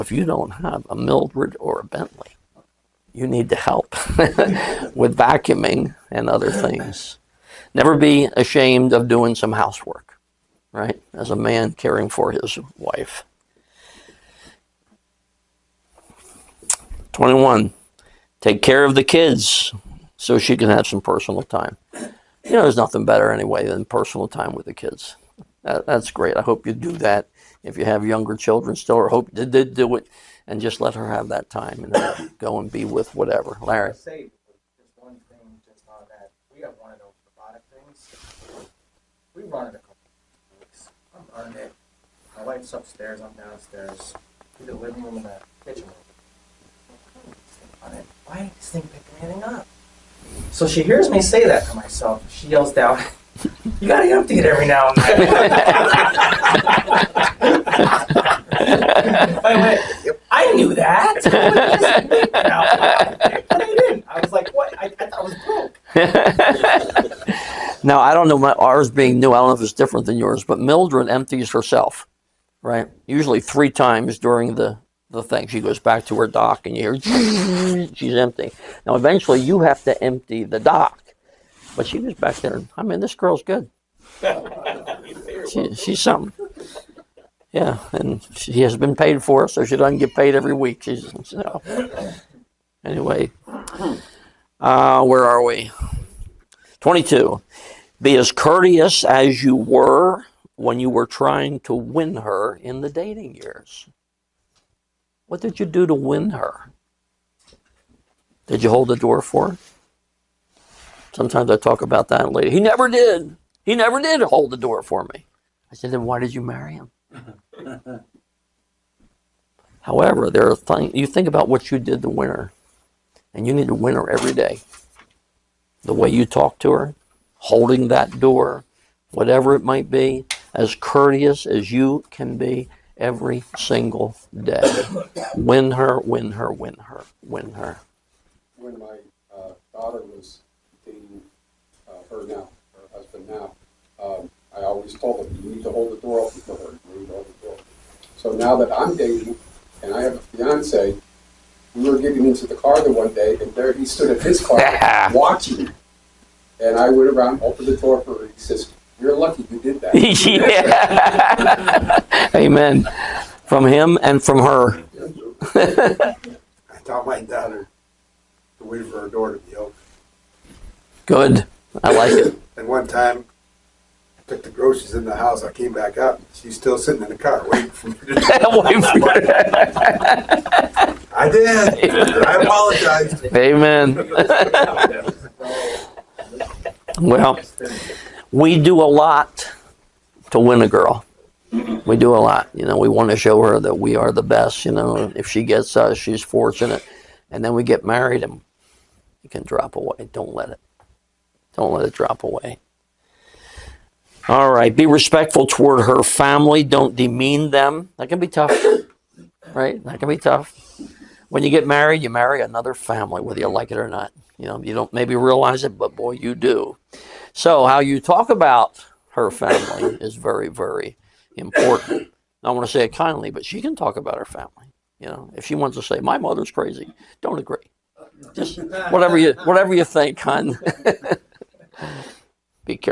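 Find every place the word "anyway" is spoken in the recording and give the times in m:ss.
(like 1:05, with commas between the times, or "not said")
0:23, 1:32.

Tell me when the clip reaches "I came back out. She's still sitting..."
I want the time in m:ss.
2:55.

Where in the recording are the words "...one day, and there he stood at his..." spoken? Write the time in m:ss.
2:32.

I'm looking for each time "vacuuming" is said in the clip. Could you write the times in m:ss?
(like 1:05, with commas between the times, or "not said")
0:05.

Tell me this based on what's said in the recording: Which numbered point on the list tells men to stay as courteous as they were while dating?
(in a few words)
22.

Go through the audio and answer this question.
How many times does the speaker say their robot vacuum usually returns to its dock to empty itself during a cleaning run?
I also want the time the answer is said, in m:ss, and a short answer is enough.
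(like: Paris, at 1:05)
3, at 1:13.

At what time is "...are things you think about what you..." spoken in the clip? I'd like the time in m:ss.
2:00.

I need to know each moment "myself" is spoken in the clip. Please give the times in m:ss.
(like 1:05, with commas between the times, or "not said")
0:51.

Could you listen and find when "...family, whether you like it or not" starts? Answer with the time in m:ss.
3:32.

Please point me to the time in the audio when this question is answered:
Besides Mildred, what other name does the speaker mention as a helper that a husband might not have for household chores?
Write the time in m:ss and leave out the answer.
0:01.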